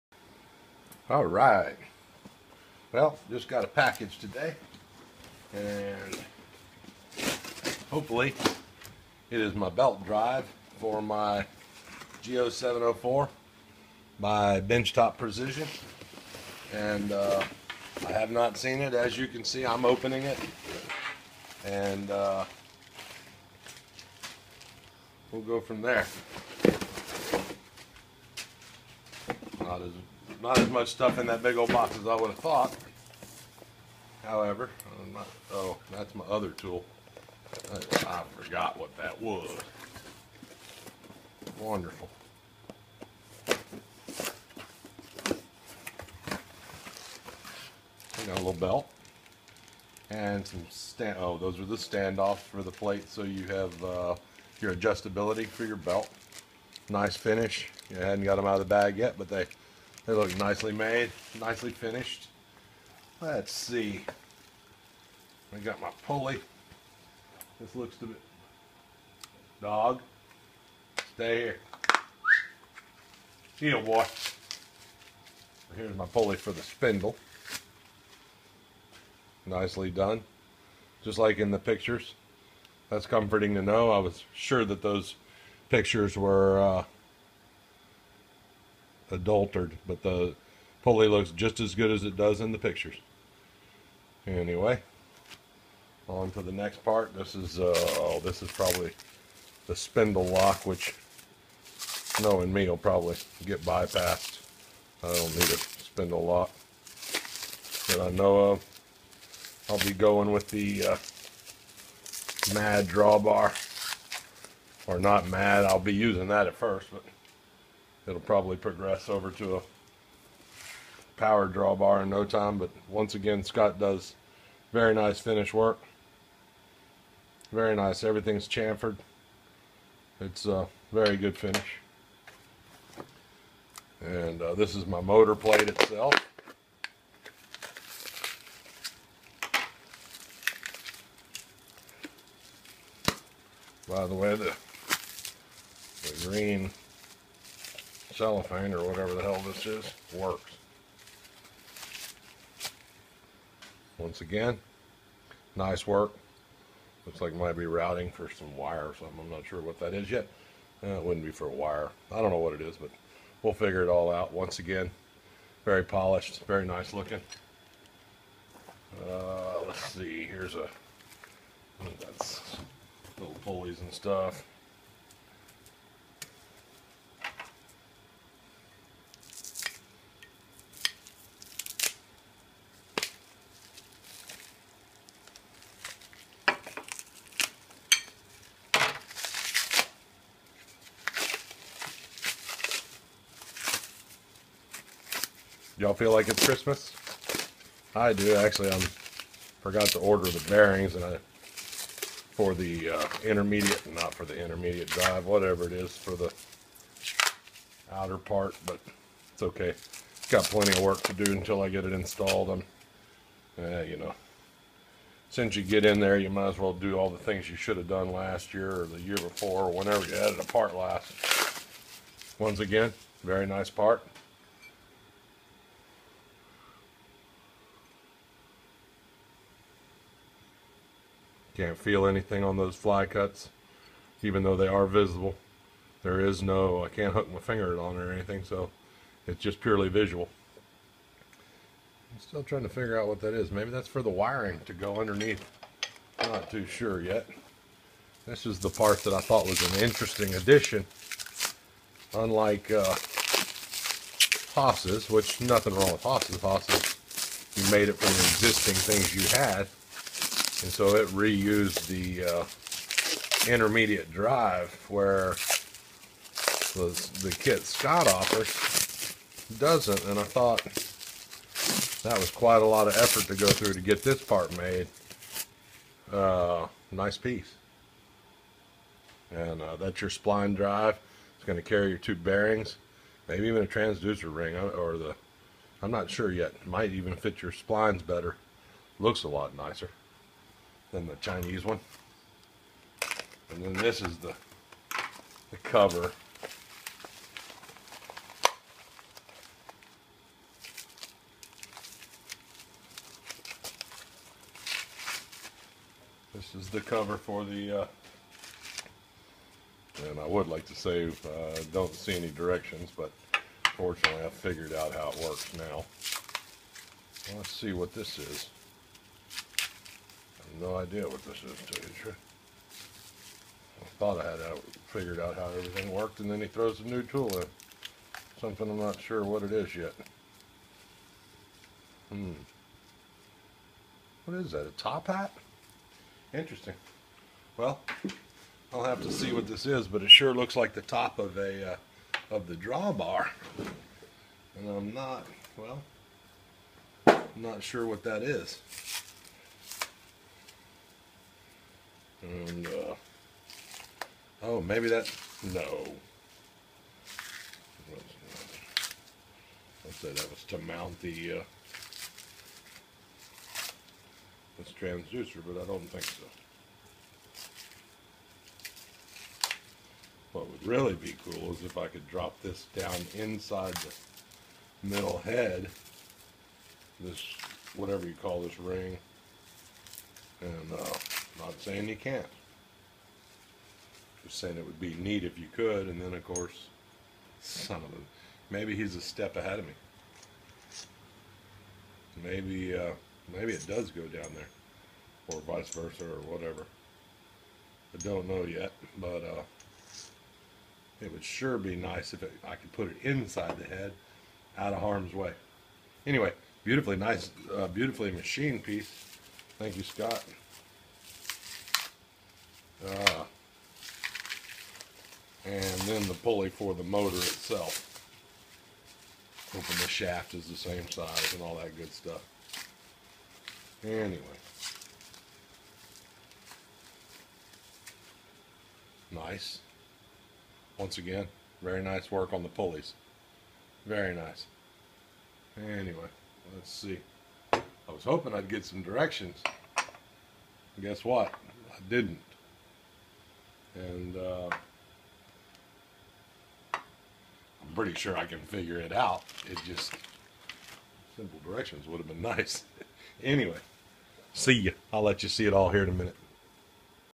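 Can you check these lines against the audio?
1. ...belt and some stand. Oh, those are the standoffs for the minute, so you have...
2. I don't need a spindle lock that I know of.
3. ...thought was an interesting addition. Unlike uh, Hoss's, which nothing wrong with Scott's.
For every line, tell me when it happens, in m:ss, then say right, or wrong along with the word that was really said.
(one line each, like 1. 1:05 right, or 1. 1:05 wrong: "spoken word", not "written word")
1. 0:48 wrong: "plate", not "minute"
2. 1:45 right
3. 4:09 wrong: "Hoss", not "Scott".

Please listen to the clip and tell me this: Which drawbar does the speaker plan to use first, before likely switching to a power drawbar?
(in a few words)
Mad drawbar.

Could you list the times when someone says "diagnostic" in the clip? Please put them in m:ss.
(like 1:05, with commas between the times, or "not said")
not said.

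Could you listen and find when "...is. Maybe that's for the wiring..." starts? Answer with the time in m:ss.
4:03.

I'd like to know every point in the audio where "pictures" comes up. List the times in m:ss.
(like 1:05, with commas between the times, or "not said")
1:21, 1:25, 1:32.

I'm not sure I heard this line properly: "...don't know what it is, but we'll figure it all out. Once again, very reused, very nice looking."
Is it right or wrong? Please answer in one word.
wrong.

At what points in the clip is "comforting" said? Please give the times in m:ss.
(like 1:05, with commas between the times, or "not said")
1:23.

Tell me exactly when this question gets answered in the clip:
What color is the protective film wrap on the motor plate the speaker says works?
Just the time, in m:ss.
2:26.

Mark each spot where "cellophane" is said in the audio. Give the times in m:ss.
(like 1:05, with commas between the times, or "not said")
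2:28.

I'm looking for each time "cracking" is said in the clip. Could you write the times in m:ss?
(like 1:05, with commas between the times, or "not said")
not said.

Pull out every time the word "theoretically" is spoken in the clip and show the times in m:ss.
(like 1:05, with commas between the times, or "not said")
not said.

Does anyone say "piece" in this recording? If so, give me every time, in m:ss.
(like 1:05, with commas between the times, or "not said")
4:37, 6:48.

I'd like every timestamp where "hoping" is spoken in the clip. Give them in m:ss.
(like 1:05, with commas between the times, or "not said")
6:59, 7:18.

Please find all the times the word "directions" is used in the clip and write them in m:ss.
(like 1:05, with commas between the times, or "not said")
5:12, 7:18, 7:31.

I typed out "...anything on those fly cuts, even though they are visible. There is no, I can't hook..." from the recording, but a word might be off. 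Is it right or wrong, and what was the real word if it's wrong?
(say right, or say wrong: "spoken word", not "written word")
right.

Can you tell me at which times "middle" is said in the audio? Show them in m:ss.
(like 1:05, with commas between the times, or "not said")
6:14.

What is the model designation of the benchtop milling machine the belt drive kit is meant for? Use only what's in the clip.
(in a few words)
G0704.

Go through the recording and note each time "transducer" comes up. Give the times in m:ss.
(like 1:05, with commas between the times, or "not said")
4:43, 6:04.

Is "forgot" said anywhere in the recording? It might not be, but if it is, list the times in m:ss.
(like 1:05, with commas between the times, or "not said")
0:38, 3:19.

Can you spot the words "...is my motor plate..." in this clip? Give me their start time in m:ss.
2:14.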